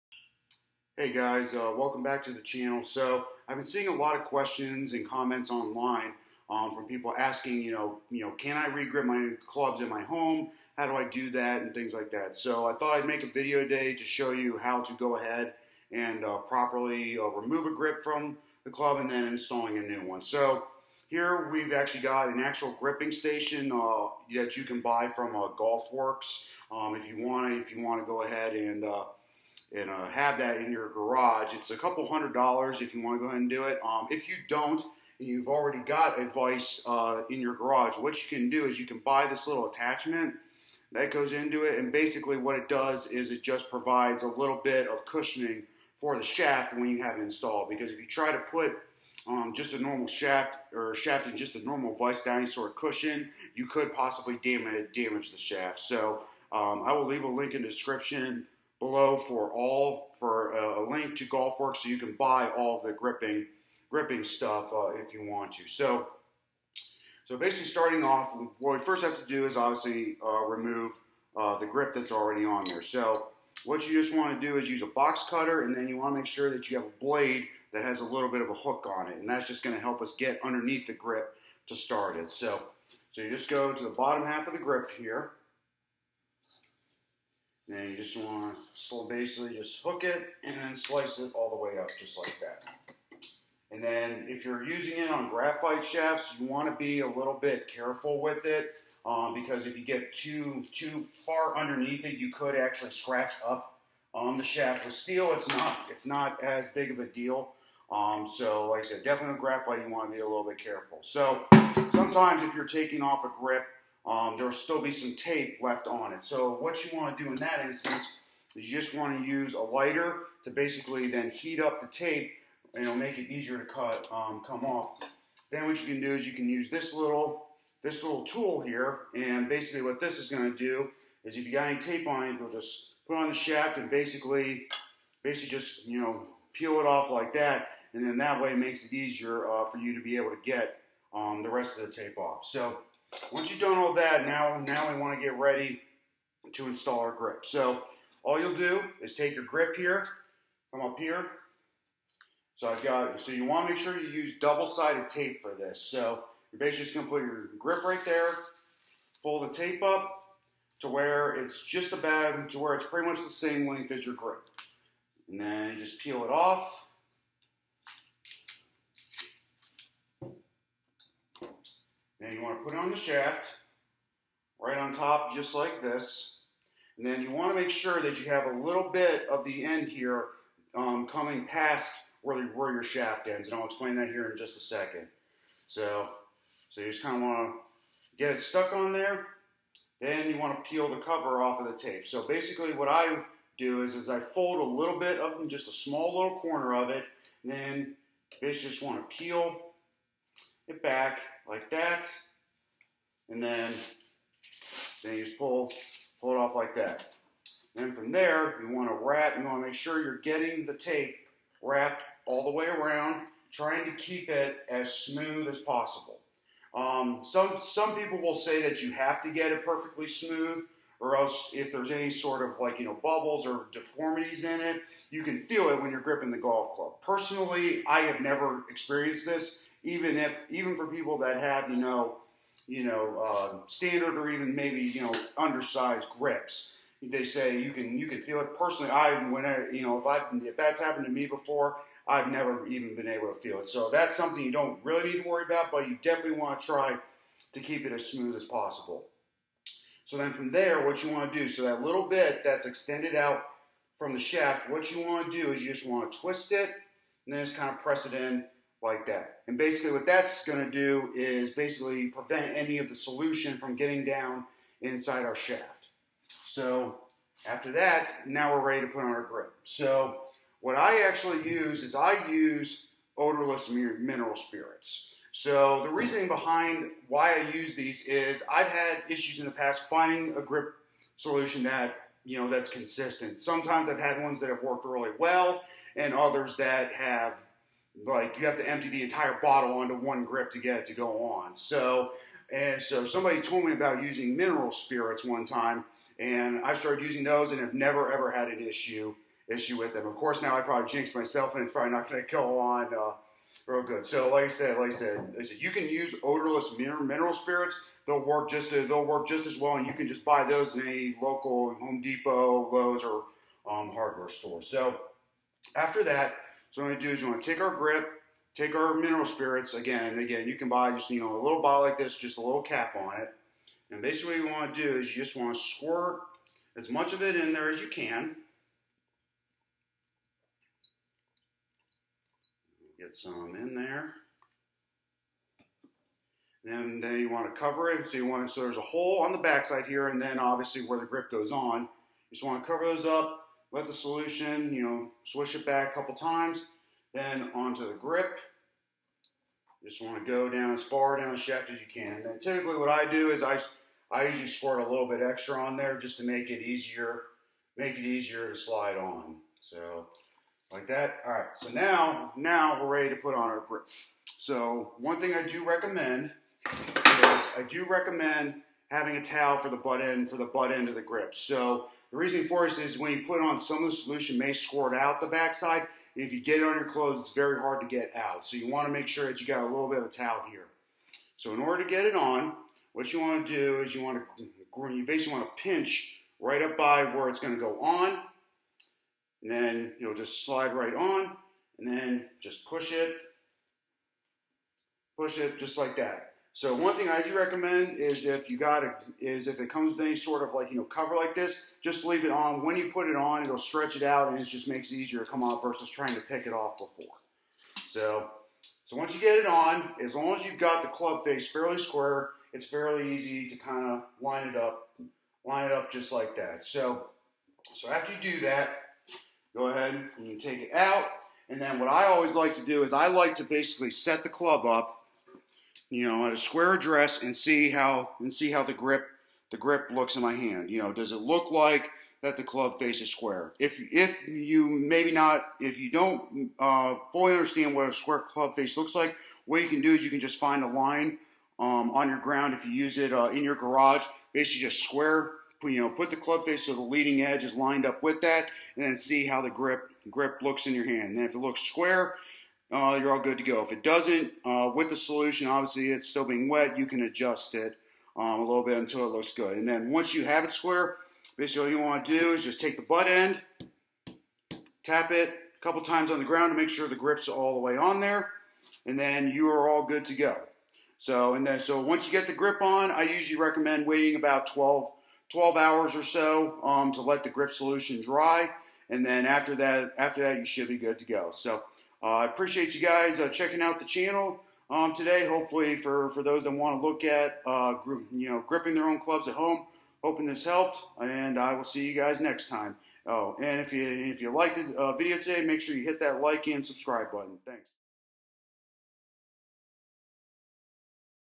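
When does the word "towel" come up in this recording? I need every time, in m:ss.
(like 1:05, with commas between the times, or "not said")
6:09, 6:20.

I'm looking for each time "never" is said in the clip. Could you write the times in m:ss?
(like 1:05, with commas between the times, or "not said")
3:48, 4:02, 4:57.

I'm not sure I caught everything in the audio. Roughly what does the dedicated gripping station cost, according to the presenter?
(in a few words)
A couple hundred dollars.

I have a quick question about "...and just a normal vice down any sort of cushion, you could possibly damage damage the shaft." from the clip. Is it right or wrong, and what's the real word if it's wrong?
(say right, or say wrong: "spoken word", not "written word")
right.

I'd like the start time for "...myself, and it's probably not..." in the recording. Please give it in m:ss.
5:01.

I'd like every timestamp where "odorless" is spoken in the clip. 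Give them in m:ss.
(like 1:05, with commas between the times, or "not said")
4:33, 5:06.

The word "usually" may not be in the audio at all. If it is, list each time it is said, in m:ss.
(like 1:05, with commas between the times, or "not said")
5:54, 7:53.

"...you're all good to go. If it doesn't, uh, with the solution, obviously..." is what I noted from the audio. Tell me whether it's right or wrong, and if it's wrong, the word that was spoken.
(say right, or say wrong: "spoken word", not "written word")
right.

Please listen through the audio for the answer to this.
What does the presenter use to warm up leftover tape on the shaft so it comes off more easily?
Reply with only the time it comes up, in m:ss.
1:59.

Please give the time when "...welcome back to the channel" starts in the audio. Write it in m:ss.
0:01.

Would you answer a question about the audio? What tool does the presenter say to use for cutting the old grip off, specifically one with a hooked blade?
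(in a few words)
Box cutter.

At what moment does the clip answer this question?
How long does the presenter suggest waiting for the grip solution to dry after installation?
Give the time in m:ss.
7:55.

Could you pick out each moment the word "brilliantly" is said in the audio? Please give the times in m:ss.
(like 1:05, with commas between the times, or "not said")
not said.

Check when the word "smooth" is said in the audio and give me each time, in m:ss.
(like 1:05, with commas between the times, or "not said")
3:34, 3:40, 4:08.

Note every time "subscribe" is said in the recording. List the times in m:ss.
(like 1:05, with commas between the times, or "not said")
8:16.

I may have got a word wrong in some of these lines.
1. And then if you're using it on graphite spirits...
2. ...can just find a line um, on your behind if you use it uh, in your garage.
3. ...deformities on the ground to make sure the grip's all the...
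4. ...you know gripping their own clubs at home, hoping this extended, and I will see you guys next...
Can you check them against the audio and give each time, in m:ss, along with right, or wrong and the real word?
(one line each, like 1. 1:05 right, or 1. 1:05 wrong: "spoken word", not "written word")
1. 1:33 wrong: "shafts", not "spirits"
2. 7:20 wrong: "ground", not "behind"
3. 7:45 wrong: "times", not "deformities"
4. 8:08 wrong: "helped", not "extended".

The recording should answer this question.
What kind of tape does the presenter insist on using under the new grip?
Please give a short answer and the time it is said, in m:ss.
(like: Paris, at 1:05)
Double-sided tape, at 2:34.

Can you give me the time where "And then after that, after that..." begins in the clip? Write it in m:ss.
7:58.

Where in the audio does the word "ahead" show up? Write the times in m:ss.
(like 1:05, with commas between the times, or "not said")
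0:15, 0:28, 0:33, 6:59.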